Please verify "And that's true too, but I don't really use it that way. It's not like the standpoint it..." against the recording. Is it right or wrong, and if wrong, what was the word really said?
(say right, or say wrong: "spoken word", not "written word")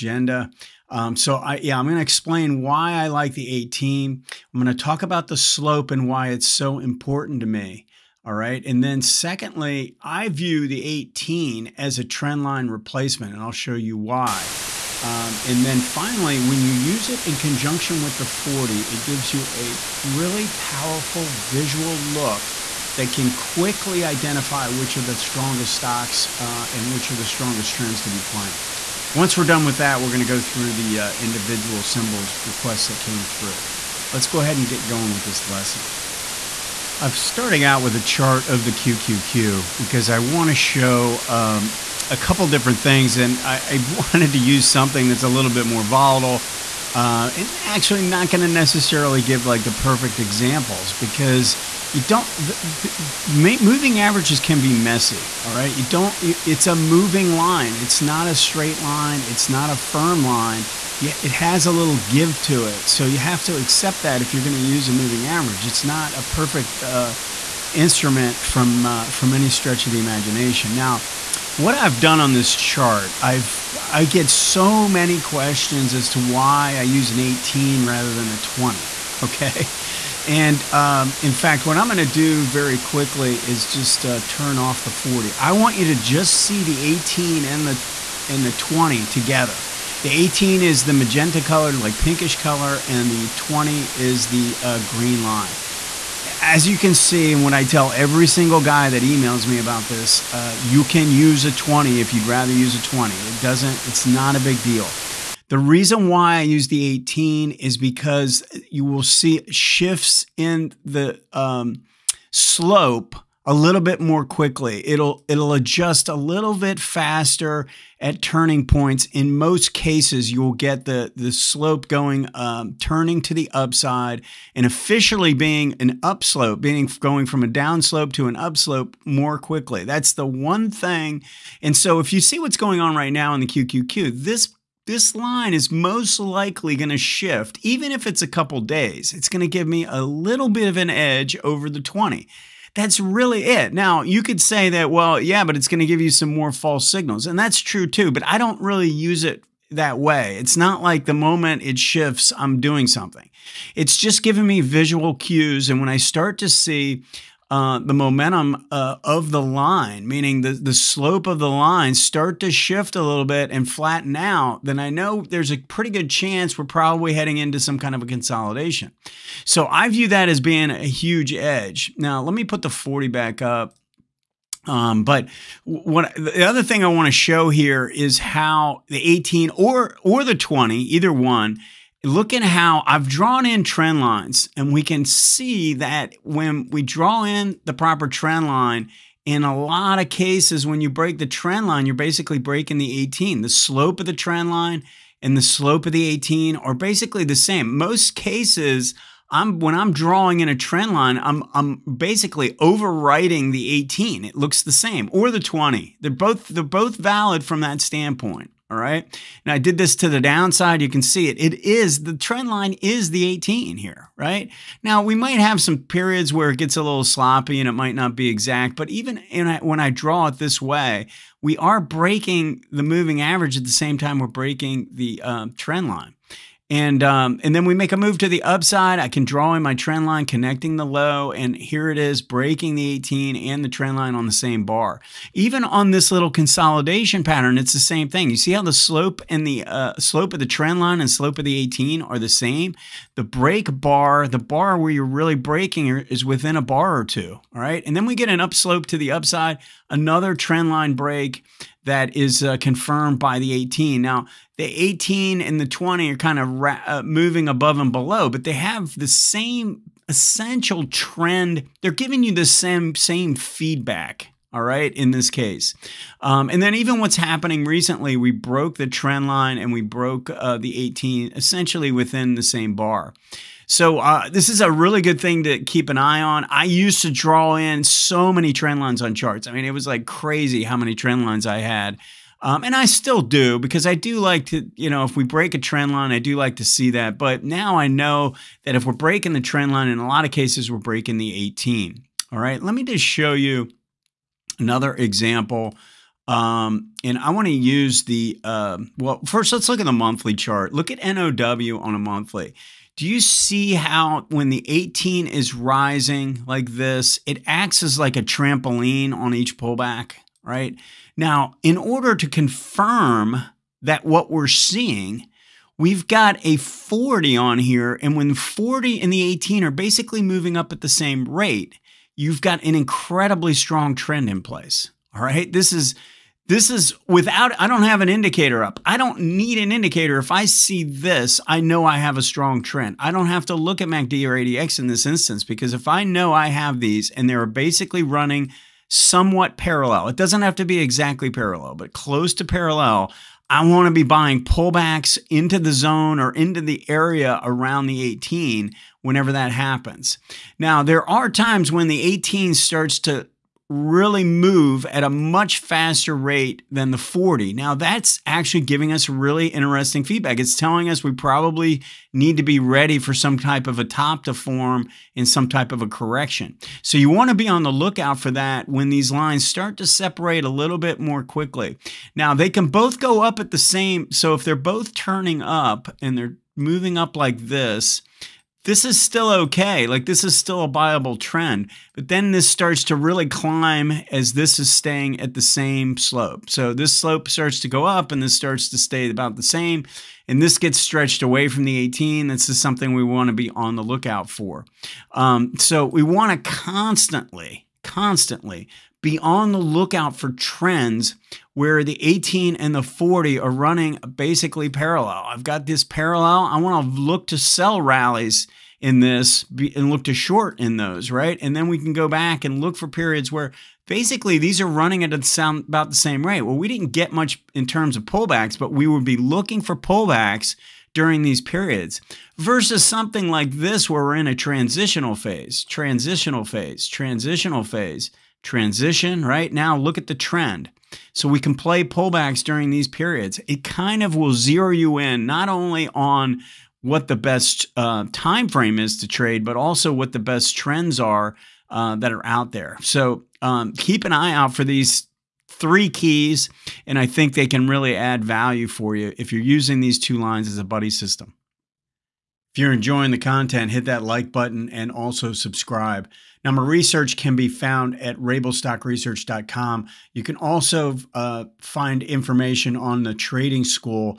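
wrong: "moment", not "standpoint".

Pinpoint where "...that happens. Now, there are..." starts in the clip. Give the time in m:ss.
5:49.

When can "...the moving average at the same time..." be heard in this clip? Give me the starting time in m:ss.
3:42.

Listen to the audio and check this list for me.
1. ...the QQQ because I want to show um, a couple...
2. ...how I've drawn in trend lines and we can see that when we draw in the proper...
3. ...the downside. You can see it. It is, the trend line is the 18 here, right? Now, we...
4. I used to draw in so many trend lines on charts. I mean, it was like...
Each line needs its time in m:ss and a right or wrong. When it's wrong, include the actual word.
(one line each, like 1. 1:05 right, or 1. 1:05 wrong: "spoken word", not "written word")
1. 0:38 right
2. 3:02 right
3. 3:30 right
4. 4:36 right.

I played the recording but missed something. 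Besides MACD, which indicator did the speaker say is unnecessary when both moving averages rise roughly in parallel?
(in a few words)
ADX.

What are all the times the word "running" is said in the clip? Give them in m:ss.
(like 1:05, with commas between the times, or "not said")
5:38, 6:43, 6:54.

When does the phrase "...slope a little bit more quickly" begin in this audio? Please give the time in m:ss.
1:52.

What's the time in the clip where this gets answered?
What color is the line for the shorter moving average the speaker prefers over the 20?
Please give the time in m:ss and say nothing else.
1:30.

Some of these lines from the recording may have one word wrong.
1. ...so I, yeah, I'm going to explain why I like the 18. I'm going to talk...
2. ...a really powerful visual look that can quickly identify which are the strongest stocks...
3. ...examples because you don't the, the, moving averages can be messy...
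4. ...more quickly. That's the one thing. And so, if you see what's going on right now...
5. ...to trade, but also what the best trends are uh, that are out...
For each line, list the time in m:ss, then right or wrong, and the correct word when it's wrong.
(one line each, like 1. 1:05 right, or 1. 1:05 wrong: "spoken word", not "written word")
1. 0:01 right
2. 0:19 right
3. 0:50 right
4. 2:09 right
5. 7:18 right.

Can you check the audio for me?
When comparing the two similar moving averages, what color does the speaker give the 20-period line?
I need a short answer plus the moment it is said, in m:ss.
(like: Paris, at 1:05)
green, at 1:34.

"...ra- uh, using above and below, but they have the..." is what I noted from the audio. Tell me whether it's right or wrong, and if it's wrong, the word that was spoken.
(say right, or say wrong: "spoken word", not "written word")
wrong: "moving", not "using".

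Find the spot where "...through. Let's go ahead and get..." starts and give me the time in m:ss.
0:33.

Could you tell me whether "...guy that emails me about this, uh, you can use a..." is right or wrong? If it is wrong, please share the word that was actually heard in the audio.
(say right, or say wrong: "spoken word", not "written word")
right.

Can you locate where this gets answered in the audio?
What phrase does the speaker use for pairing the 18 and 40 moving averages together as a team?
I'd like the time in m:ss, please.
7:30.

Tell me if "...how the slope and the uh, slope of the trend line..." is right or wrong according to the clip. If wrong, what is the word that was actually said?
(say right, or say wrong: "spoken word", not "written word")
right.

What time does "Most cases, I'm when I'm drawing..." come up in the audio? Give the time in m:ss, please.
3:17.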